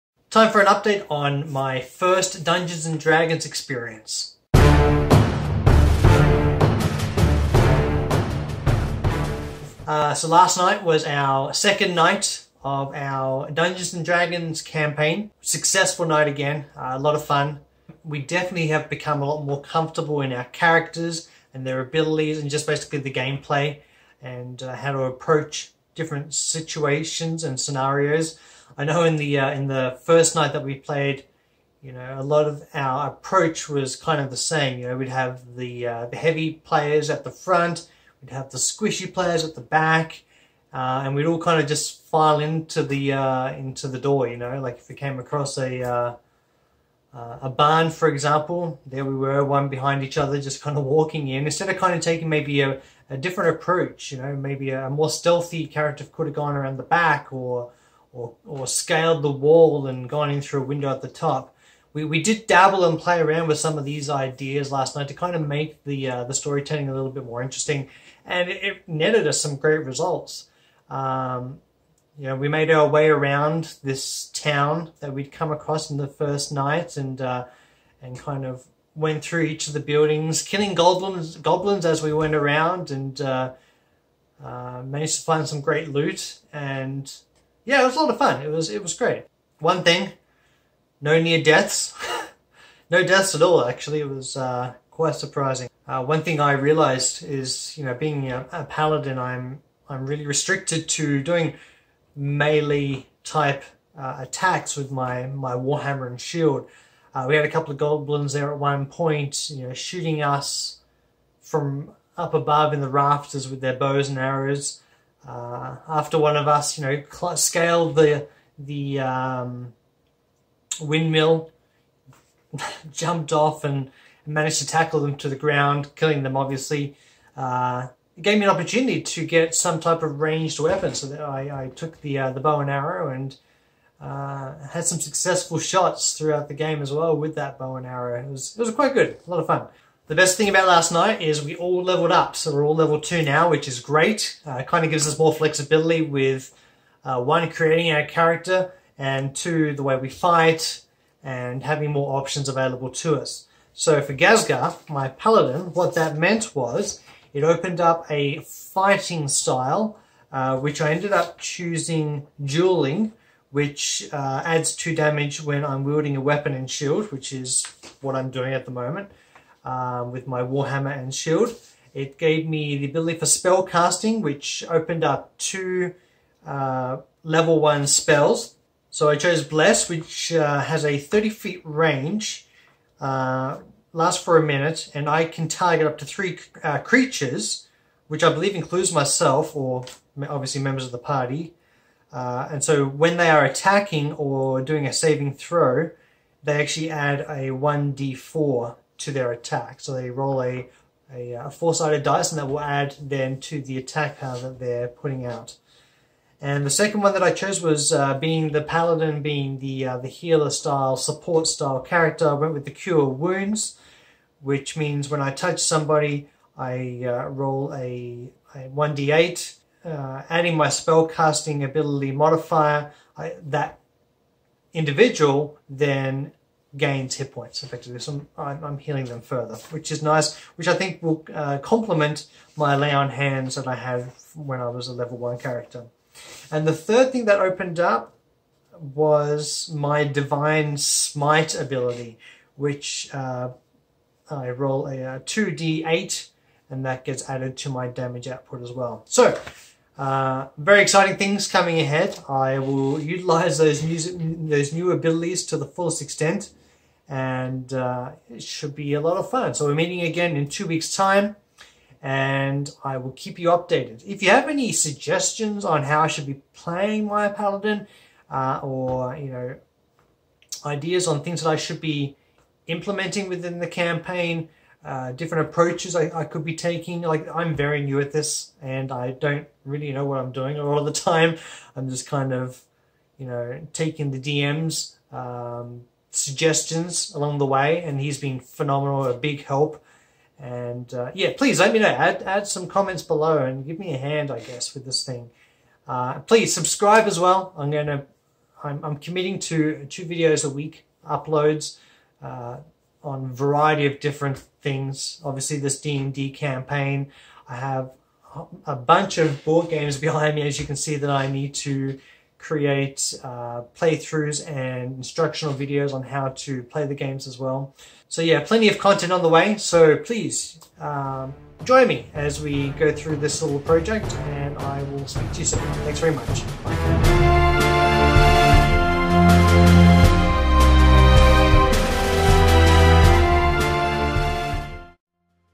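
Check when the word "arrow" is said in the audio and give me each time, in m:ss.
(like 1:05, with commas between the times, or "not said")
1:54, 2:12, 2:17.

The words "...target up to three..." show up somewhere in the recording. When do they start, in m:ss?
3:05.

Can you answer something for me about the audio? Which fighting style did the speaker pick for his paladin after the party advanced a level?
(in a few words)
dueling.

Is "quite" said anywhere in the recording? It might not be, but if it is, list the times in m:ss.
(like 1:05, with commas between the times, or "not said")
1:34, 2:18.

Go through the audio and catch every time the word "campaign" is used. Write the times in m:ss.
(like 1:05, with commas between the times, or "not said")
0:14, 4:33, 5:06.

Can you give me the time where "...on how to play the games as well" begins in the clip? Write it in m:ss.
5:15.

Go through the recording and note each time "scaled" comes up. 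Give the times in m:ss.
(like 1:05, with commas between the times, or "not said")
0:58, 1:57.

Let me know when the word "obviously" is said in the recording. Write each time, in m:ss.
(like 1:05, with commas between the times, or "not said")
2:06, 3:10, 5:05.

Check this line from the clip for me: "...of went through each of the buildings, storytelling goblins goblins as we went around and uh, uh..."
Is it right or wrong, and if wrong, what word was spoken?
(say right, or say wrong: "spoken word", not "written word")
wrong: "killing", not "storytelling".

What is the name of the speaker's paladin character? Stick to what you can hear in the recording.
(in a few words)
Gazgar.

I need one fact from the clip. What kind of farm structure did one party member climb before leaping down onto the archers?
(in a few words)
windmill.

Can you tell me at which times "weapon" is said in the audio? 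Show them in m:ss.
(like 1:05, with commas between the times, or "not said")
2:10, 2:46.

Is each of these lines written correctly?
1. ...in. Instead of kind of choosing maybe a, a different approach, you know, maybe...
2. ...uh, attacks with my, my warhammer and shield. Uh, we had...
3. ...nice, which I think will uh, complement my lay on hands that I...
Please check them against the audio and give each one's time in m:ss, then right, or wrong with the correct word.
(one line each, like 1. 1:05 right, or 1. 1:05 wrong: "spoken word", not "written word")
1. 0:51 wrong: "taking", not "choosing"
2. 1:43 right
3. 3:50 right.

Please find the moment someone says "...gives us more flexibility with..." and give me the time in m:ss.
2:24.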